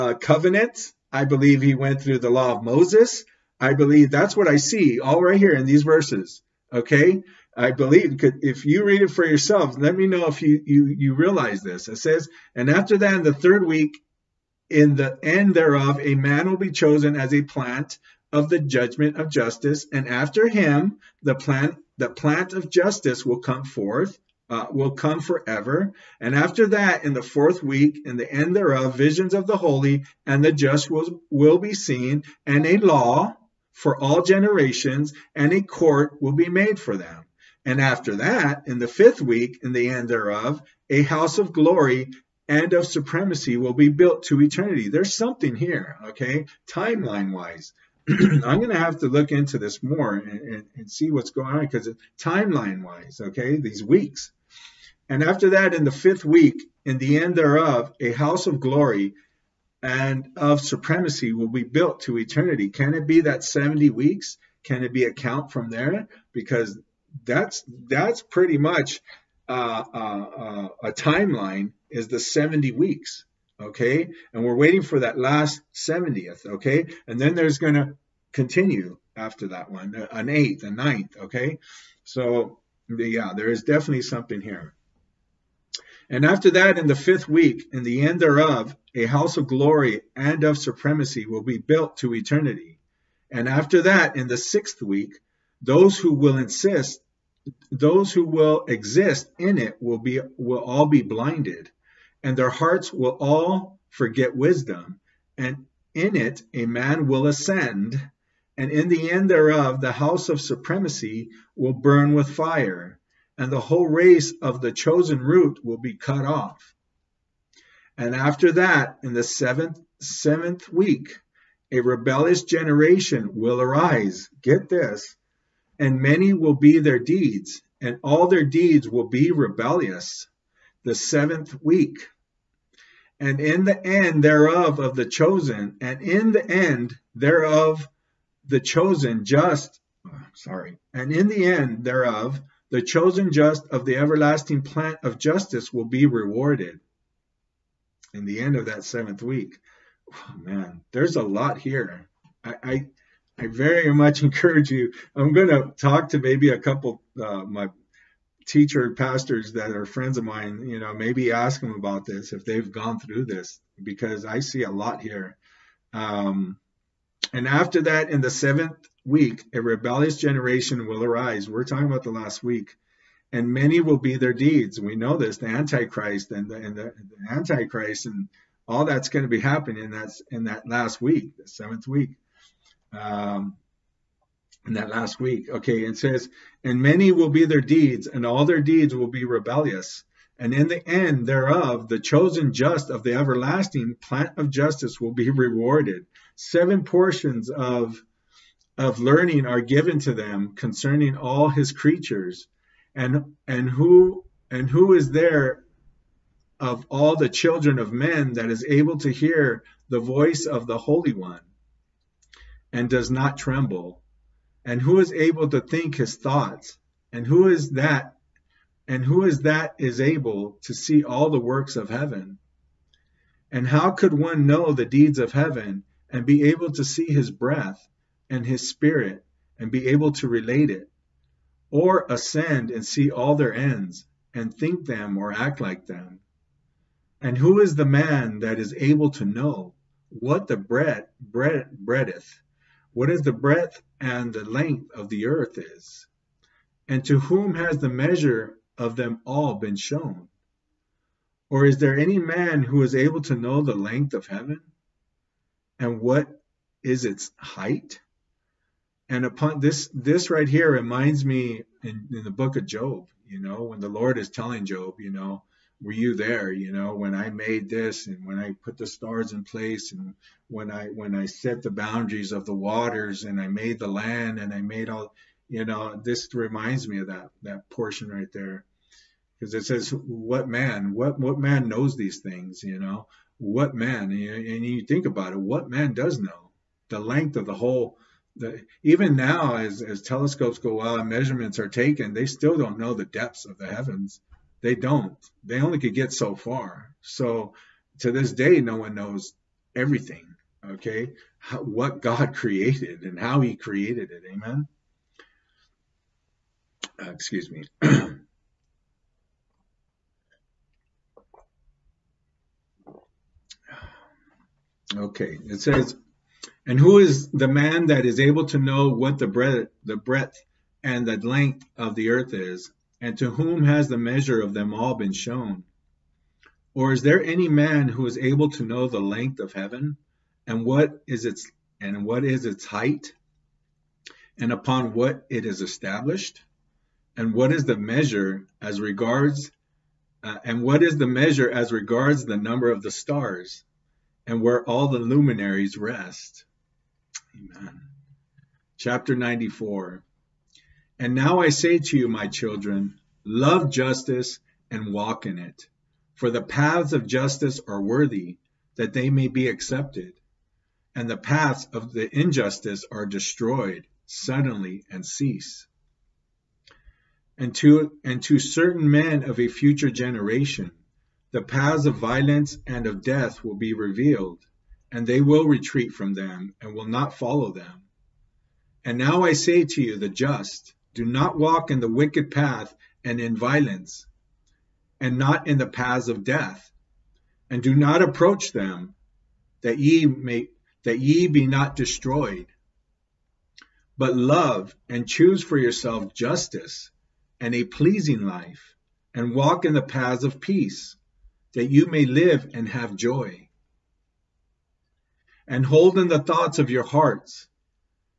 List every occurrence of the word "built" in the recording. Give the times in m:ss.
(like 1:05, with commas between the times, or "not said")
0:43, 1:01, 1:31.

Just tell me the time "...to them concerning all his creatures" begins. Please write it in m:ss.
3:19.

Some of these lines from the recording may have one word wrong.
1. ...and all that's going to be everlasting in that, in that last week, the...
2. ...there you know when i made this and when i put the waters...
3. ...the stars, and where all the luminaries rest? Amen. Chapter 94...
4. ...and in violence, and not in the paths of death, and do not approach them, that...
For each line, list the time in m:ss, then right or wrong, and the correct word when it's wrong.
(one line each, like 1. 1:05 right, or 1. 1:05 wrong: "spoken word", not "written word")
1. 2:58 wrong: "happening", not "everlasting"
2. 4:26 wrong: "stars", not "waters"
3. 5:42 right
4. 6:23 right.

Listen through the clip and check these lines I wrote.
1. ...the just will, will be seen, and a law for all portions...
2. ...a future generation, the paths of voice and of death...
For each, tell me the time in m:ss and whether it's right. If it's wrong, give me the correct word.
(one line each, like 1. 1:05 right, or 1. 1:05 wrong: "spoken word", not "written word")
1. 0:30 wrong: "generations", not "portions"
2. 6:09 wrong: "violence", not "voice".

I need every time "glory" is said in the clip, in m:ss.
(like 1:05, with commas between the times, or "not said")
0:41, 0:58, 1:29.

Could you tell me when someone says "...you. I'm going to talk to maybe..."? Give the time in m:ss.
2:34.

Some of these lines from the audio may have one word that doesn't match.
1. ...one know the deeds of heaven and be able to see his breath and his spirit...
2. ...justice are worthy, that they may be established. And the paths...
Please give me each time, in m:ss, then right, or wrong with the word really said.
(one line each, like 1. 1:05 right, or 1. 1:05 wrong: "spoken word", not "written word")
1. 3:44 right
2. 5:57 wrong: "accepted", not "established".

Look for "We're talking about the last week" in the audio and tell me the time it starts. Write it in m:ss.
2:51.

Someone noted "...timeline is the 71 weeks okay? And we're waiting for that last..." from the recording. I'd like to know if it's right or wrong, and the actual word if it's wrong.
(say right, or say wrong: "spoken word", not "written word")
wrong: "70", not "71".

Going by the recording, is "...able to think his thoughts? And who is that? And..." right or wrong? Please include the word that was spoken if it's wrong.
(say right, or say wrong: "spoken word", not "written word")
right.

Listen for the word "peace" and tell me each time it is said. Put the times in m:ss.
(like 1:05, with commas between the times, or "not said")
6:40.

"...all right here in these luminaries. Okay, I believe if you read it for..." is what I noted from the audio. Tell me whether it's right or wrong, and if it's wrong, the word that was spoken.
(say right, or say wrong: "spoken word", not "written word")
wrong: "verses", not "luminaries".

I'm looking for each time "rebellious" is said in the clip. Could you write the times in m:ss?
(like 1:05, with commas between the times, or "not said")
2:01, 2:09, 2:49, 3:09.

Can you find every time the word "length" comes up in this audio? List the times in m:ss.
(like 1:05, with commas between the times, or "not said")
4:04, 4:13, 4:46, 5:21, 5:29.